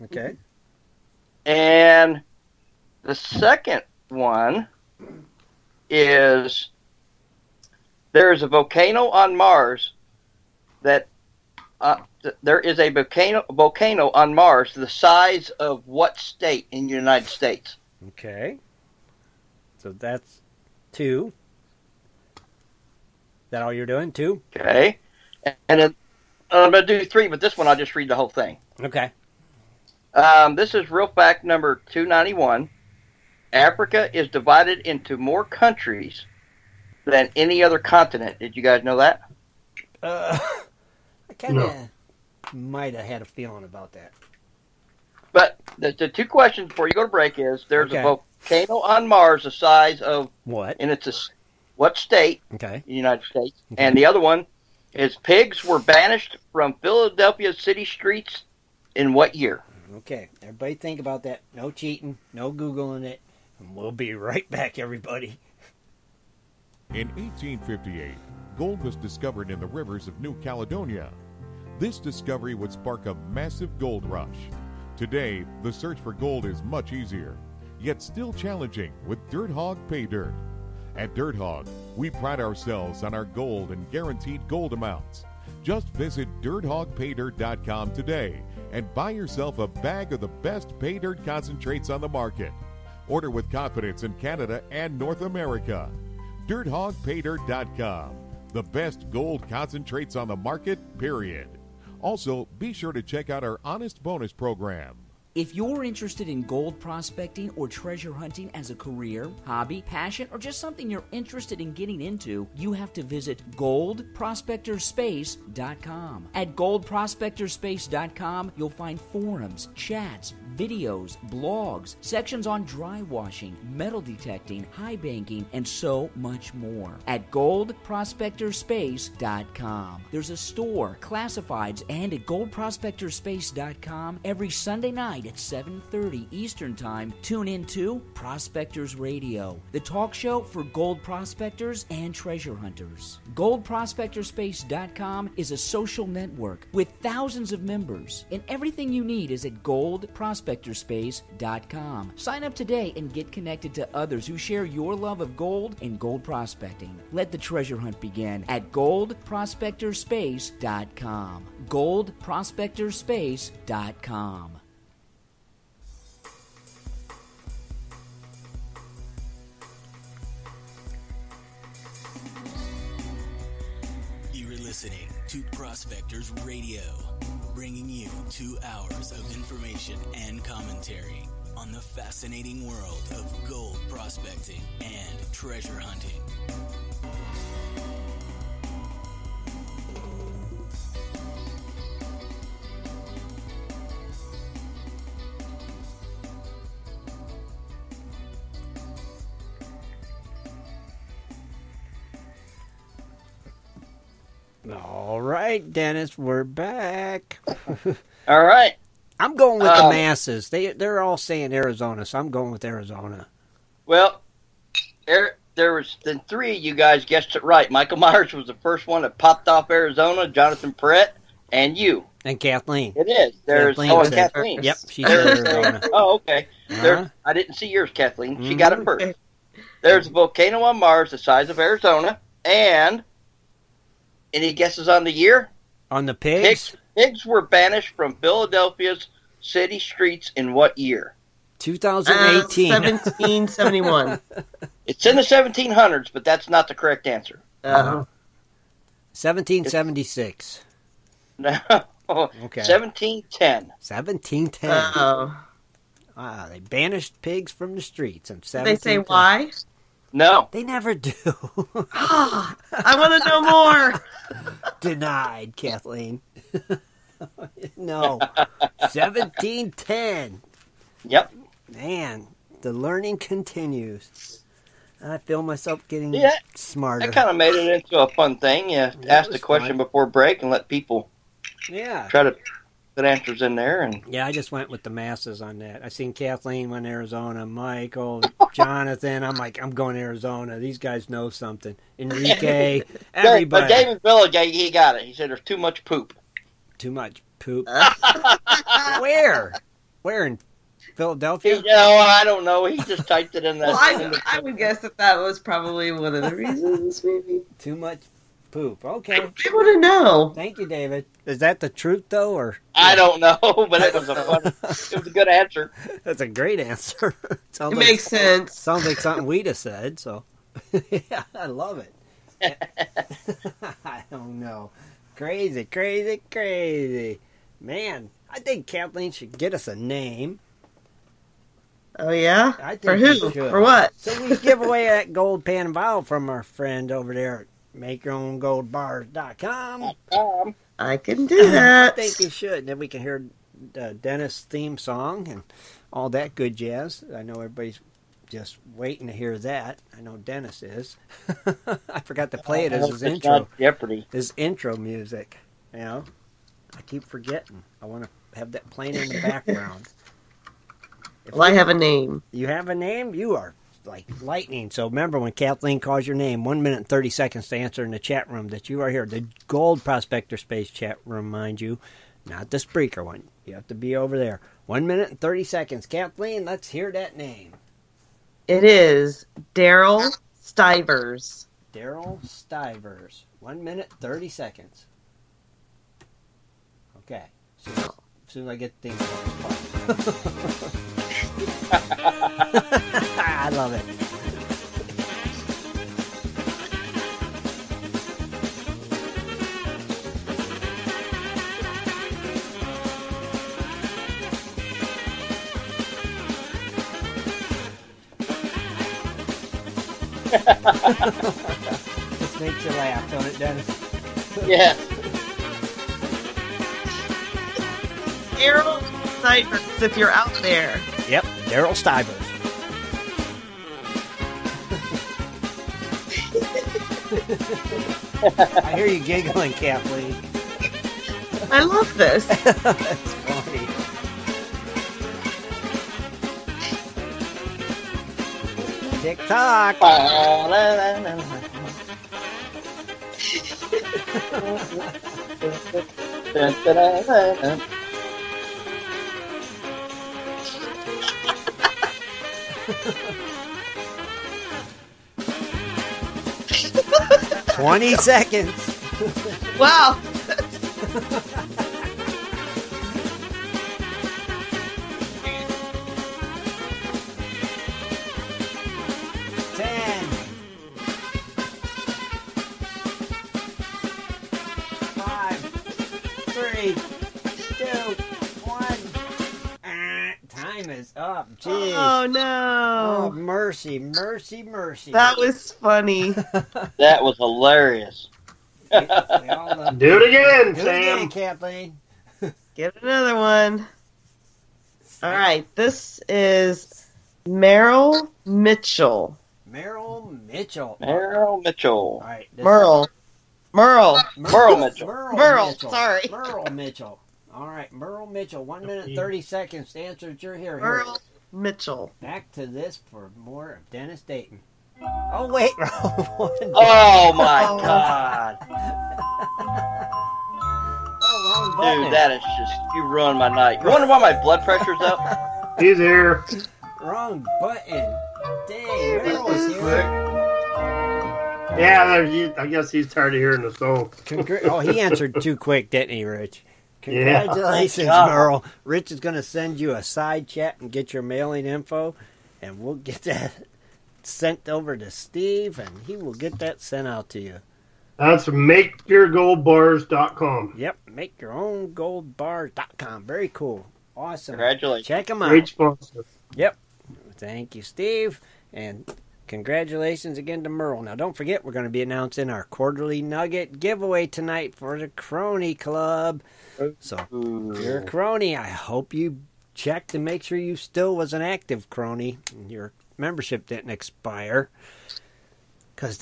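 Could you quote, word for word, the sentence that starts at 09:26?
So, you're a crony, I hope you checked to make sure you still was an active crony and your membership didn't expire.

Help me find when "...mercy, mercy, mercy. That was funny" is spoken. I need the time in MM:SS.
08:03.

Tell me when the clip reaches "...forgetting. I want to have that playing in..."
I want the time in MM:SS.
05:57.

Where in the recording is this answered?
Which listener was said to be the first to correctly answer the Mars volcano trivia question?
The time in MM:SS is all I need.
03:37.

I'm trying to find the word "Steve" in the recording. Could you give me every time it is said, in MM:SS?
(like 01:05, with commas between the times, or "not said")
09:04, 09:17.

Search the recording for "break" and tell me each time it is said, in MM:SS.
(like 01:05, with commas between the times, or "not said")
00:47, 04:40.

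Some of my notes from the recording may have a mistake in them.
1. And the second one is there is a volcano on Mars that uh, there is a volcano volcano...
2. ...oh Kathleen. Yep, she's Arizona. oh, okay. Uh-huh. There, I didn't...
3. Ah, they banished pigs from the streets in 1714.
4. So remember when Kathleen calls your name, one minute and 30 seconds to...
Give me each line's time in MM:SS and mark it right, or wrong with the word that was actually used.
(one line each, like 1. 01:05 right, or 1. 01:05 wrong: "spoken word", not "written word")
1. 00:01 right
2. 03:43 right
3. 04:16 wrong: "1710", not "1714"
4. 06:04 right.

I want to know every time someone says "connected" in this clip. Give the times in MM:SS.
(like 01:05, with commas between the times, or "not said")
02:33.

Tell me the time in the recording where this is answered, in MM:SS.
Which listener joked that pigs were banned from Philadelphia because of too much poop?
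04:53.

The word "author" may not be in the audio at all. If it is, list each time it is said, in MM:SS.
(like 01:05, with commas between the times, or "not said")
not said.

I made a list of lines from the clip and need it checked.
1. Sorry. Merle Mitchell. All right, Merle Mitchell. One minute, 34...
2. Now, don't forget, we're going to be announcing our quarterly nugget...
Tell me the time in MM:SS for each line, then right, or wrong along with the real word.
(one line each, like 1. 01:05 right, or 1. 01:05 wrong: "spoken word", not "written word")
1. 08:25 wrong: "30", not "34"
2. 09:20 right.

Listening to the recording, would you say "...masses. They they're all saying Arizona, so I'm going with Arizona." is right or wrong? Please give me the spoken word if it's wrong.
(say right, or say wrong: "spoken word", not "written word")
right.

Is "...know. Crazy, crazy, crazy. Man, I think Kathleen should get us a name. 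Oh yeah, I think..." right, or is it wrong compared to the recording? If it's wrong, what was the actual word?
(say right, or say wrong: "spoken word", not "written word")
right.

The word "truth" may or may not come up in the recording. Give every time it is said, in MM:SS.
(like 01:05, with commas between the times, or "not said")
05:11.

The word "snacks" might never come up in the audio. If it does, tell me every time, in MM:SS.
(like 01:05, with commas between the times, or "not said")
not said.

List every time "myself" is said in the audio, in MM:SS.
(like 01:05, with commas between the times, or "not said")
04:35.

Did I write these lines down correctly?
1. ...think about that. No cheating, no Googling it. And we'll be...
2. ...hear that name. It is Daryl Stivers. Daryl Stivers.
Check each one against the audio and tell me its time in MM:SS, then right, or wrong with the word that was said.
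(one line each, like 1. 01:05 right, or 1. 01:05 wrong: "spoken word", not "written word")
1. 01:00 right
2. 06:16 right.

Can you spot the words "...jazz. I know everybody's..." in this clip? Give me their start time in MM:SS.
05:46.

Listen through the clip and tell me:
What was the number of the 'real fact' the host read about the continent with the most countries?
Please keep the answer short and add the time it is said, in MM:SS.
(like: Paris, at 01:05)
291, at 00:31.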